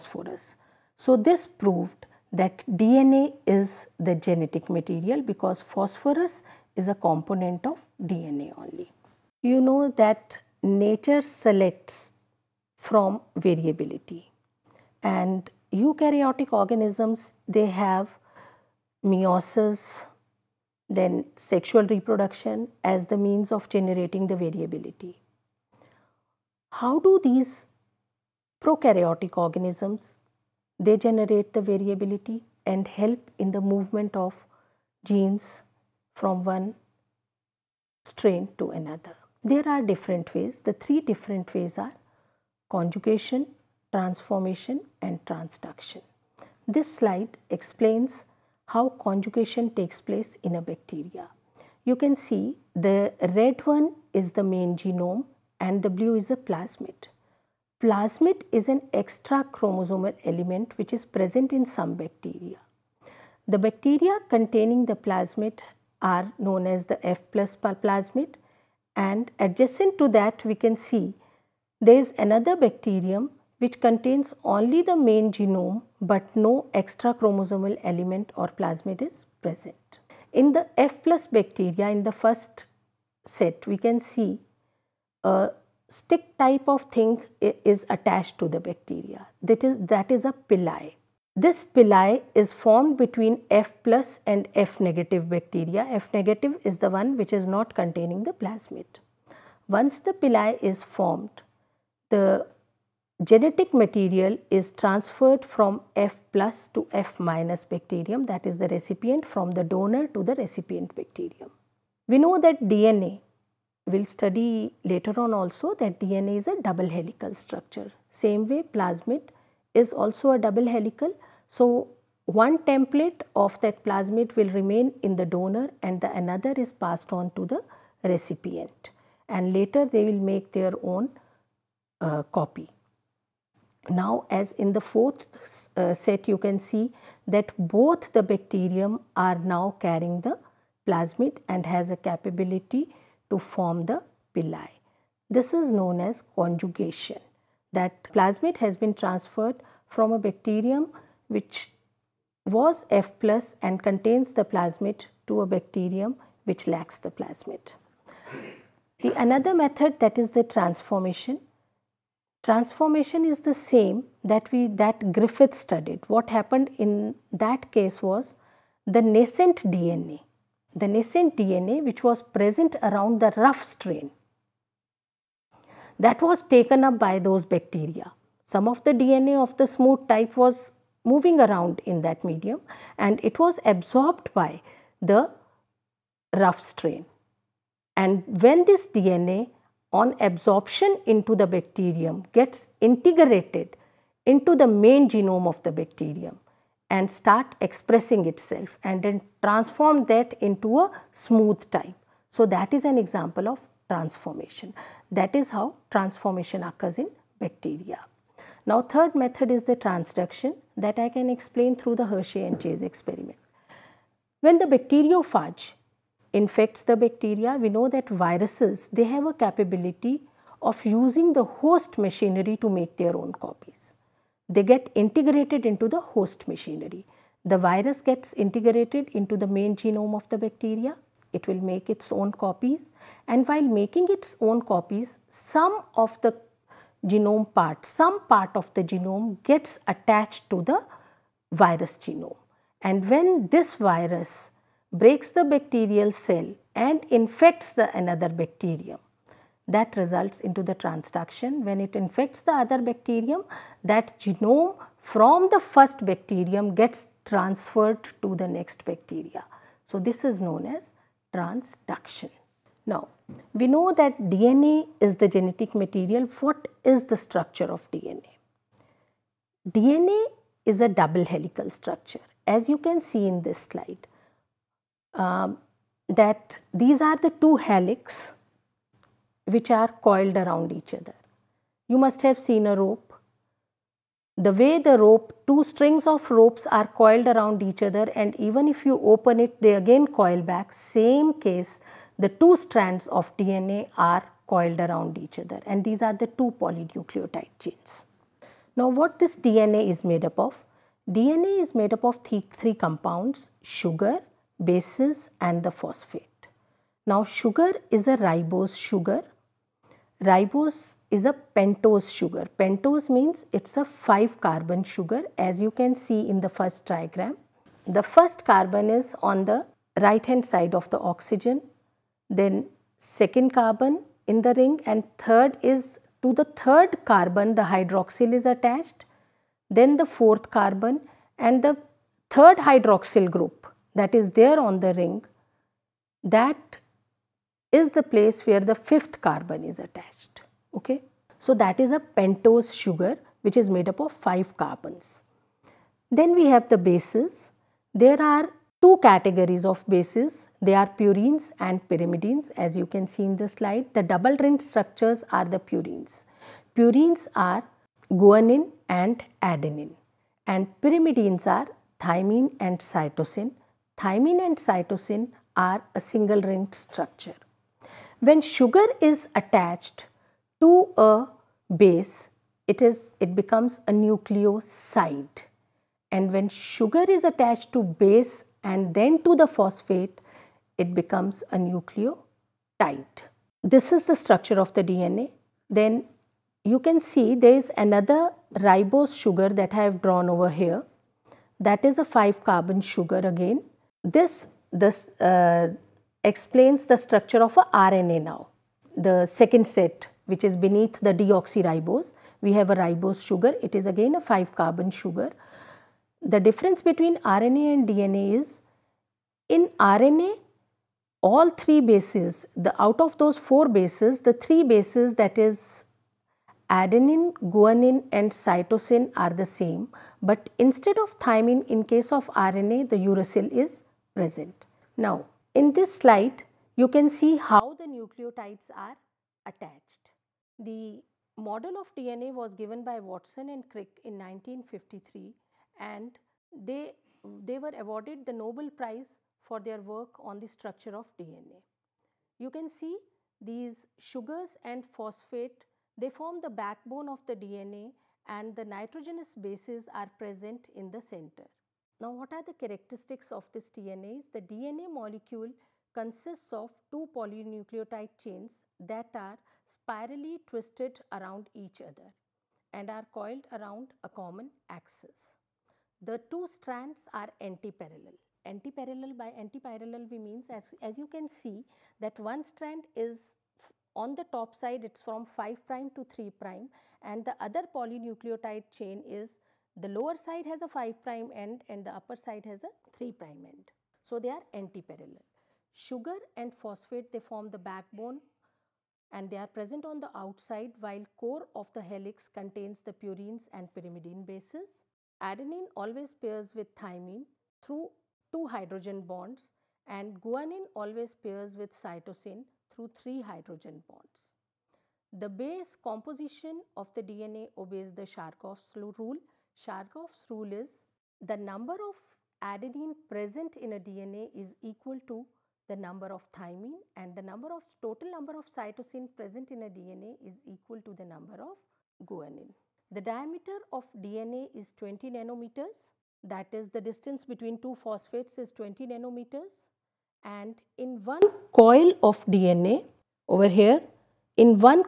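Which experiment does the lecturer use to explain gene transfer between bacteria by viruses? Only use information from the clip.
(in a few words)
Hershey and Chase experiment.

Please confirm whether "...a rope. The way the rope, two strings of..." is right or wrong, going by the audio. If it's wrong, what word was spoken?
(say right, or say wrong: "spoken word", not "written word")
right.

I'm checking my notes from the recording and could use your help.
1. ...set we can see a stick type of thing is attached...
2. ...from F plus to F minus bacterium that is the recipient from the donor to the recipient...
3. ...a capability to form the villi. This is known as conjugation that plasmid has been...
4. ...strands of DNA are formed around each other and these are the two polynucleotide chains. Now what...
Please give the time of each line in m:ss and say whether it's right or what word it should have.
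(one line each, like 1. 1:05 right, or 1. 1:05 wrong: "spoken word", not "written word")
1. 1:23 right
2. 1:45 right
3. 2:21 right
4. 4:52 wrong: "coiled", not "formed".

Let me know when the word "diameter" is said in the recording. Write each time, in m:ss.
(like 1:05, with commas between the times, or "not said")
8:42.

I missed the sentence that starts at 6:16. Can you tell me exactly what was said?
And when sugar is attached to base and then to the phosphate, it becomes a nucleotide.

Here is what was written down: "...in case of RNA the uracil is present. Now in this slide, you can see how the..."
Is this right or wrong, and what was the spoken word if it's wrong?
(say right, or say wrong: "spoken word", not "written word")
right.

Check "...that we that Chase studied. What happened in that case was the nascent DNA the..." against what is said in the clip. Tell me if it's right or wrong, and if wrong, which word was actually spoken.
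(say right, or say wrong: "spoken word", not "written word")
wrong: "Griffith", not "Chase".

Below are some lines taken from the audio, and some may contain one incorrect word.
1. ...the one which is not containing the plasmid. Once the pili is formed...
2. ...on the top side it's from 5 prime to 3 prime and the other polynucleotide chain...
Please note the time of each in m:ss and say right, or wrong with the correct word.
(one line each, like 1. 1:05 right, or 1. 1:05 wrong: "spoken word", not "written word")
1. 1:36 right
2. 7:53 right.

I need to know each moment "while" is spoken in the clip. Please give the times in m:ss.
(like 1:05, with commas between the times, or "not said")
3:53, 8:10.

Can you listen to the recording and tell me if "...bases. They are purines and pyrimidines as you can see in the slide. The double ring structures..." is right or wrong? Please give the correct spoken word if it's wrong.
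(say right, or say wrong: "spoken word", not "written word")
right.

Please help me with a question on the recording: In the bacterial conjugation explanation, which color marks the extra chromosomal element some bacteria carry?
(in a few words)
Blue.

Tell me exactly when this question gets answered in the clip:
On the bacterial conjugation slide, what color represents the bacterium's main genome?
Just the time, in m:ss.
0:53.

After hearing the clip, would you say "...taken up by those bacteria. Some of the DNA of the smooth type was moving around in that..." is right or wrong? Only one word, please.
right.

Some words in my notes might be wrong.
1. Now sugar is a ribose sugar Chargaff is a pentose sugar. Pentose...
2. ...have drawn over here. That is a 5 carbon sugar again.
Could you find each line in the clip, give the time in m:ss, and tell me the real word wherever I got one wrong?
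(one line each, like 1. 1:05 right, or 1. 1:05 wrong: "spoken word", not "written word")
1. 5:07 wrong: "Ribose", not "Chargaff"
2. 6:29 right.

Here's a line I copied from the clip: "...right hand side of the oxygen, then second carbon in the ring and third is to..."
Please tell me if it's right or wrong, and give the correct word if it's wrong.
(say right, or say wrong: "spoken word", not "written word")
right.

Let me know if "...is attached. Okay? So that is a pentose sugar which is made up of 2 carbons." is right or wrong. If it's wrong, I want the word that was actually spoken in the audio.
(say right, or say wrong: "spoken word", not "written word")
wrong: "5", not "2".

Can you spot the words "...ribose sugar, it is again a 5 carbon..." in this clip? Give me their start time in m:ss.
6:42.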